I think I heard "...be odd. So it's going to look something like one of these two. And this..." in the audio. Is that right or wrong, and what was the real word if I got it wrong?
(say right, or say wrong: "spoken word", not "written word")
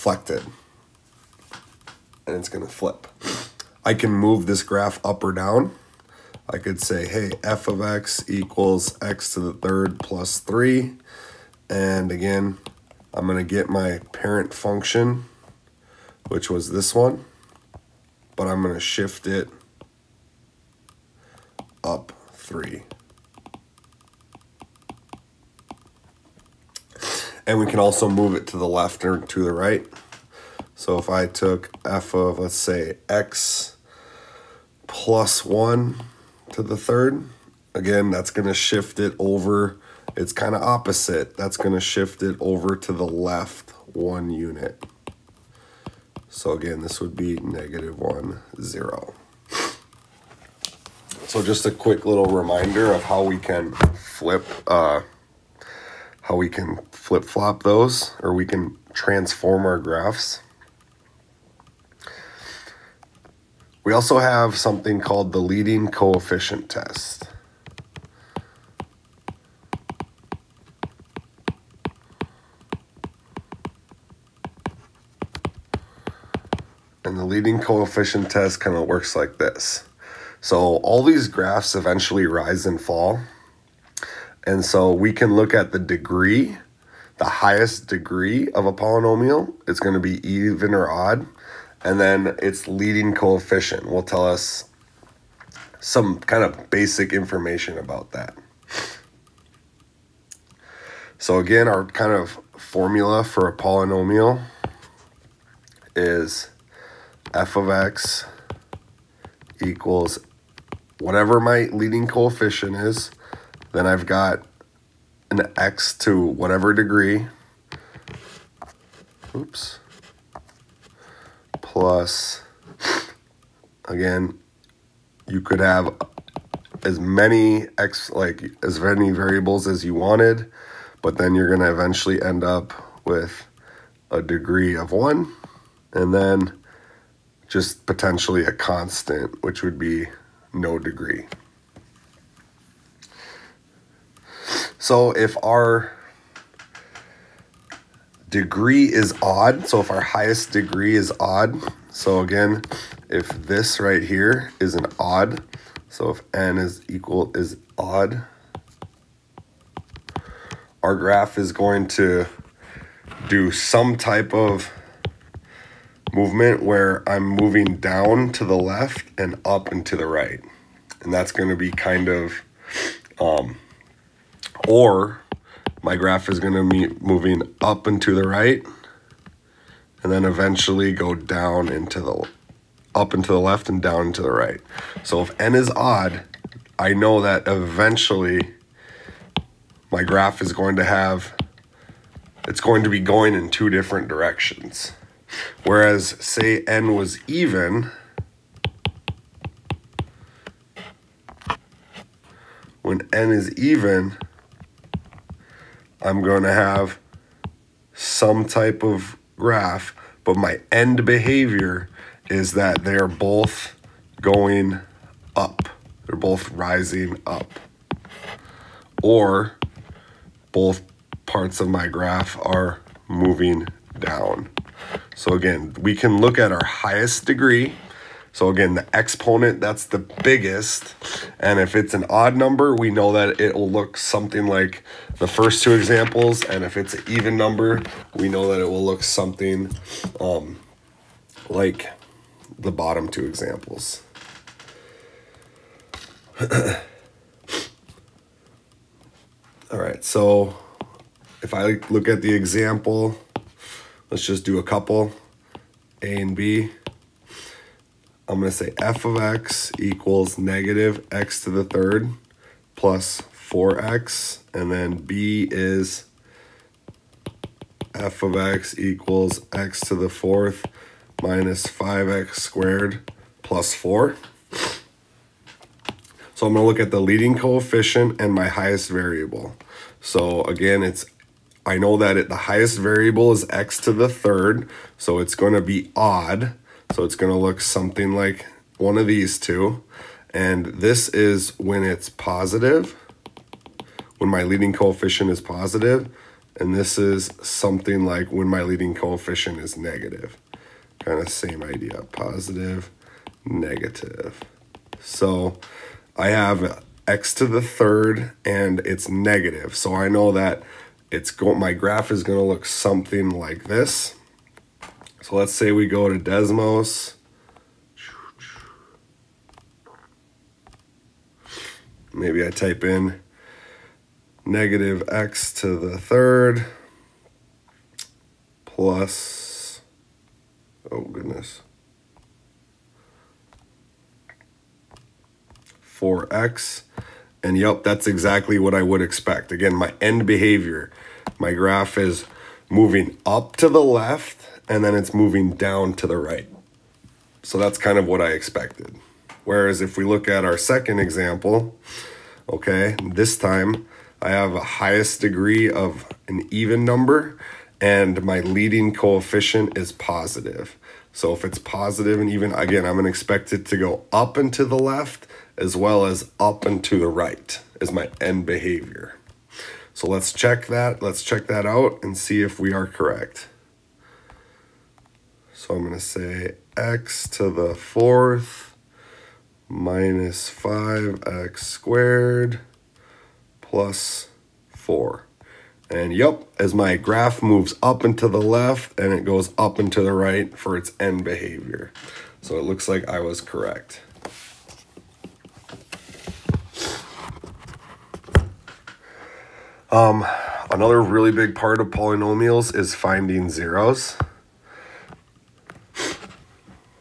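right.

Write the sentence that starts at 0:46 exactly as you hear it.
So again, this would be negative one, zero.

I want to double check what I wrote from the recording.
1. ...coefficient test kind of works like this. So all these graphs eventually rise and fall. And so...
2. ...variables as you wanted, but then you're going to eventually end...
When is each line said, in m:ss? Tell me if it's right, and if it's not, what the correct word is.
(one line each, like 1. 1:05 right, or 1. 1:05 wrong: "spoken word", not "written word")
1. 1:17 right
2. 2:09 right.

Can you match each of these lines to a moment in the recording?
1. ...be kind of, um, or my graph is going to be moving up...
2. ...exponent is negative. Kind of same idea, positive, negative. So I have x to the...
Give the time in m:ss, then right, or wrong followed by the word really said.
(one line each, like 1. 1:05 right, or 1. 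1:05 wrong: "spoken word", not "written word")
1. 2:51 right
2. 4:58 wrong: "coefficient", not "exponent".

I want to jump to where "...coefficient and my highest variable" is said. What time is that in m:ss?
4:37.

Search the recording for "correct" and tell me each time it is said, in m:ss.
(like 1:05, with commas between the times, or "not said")
6:12, 6:33.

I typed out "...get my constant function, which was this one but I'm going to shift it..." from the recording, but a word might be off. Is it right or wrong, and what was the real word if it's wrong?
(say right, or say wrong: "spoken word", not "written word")
wrong: "parent", not "constant".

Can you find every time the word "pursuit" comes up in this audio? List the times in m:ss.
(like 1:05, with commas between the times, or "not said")
not said.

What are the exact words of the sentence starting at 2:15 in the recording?
And then just potentially a constant, which would be no degree.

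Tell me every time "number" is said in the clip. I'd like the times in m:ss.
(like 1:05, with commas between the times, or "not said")
3:52, 3:57, 5:56.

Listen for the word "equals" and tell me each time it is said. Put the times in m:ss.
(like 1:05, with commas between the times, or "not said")
0:08, 1:49, 2:36, 4:19, 4:28.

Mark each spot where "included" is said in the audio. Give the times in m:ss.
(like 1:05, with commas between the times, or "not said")
not said.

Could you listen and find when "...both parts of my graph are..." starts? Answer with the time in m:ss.
3:40.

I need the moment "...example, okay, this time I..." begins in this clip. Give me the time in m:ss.
5:50.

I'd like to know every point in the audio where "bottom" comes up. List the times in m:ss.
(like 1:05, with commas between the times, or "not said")
4:02.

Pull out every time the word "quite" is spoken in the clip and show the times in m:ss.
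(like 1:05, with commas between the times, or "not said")
not said.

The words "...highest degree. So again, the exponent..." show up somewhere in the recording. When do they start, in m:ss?
3:46.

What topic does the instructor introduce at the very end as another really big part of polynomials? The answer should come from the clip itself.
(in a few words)
finding zeros.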